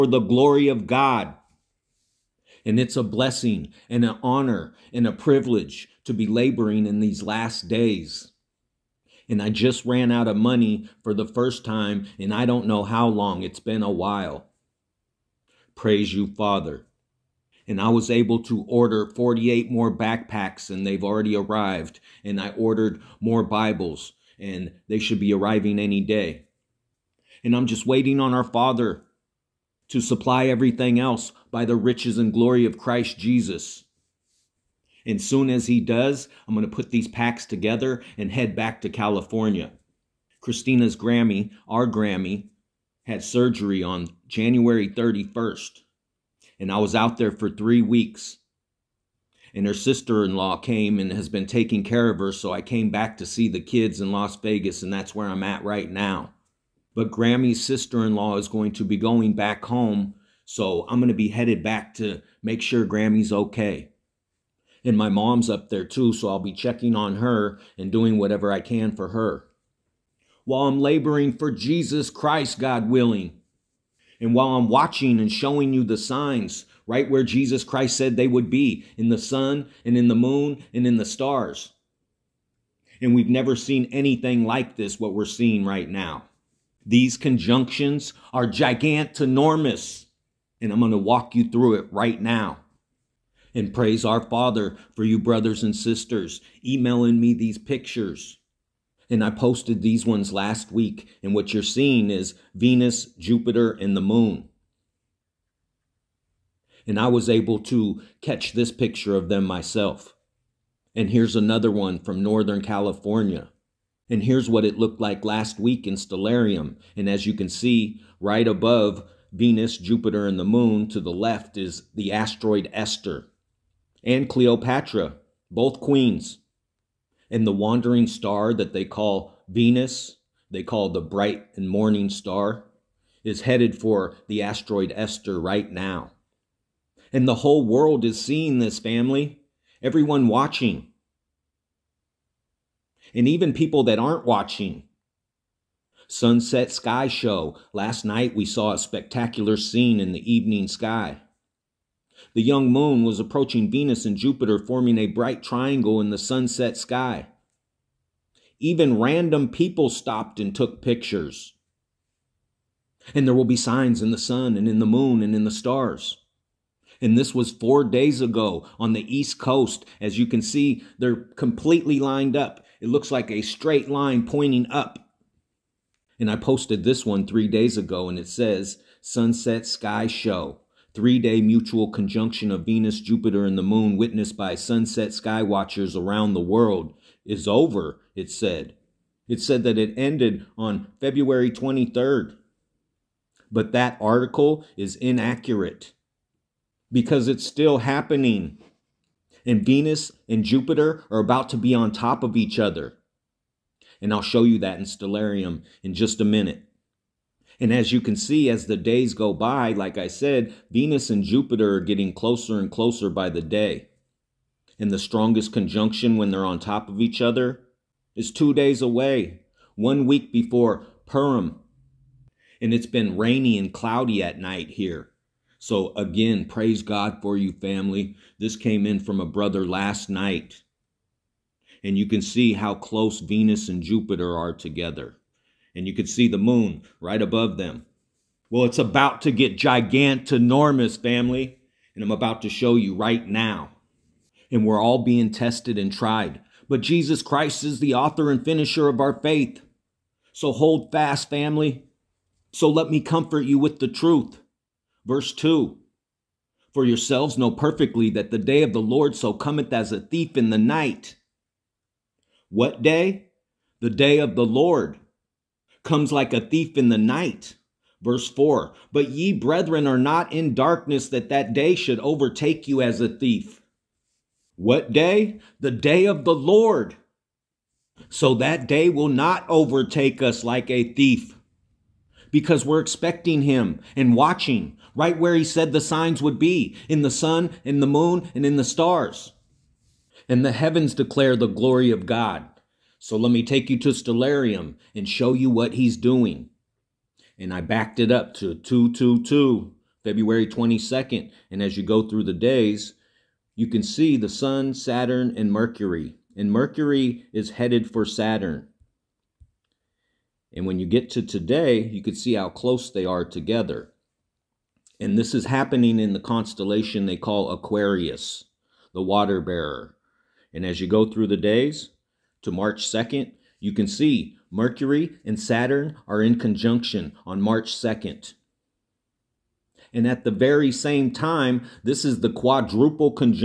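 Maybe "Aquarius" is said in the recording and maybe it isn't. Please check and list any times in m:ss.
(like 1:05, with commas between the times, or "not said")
5:17.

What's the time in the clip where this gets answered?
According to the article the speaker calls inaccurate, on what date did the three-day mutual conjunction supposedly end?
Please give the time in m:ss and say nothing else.
3:10.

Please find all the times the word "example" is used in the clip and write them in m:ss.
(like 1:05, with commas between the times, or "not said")
not said.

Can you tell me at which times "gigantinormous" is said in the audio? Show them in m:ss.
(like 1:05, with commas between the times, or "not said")
1:28, 3:59.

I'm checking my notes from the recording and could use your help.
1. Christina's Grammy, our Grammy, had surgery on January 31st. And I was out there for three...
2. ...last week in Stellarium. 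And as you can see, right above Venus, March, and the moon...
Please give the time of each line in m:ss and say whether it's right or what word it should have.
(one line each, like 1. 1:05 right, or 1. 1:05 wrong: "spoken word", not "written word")
1. 0:40 right
2. 1:55 wrong: "Jupiter", not "March".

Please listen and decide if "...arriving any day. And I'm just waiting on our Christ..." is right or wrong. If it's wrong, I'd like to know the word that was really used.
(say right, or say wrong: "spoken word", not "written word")
wrong: "Father", not "Christ".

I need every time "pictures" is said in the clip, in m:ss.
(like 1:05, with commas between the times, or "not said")
1:37, 1:48, 2:40.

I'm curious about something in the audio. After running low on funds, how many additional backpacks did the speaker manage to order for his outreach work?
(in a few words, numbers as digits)
48.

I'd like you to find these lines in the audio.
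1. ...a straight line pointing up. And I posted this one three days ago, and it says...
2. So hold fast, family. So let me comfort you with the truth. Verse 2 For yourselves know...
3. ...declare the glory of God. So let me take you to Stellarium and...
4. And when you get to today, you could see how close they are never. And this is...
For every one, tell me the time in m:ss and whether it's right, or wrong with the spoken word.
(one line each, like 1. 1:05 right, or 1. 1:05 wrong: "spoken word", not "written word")
1. 2:53 right
2. 4:10 right
3. 4:50 right
4. 5:10 wrong: "together", not "never".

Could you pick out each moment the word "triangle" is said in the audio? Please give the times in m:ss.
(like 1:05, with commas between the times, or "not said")
2:35.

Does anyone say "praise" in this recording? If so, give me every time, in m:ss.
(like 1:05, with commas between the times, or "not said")
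0:15, 1:33, 3:46.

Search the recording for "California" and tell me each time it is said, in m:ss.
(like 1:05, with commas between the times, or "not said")
0:38, 1:52.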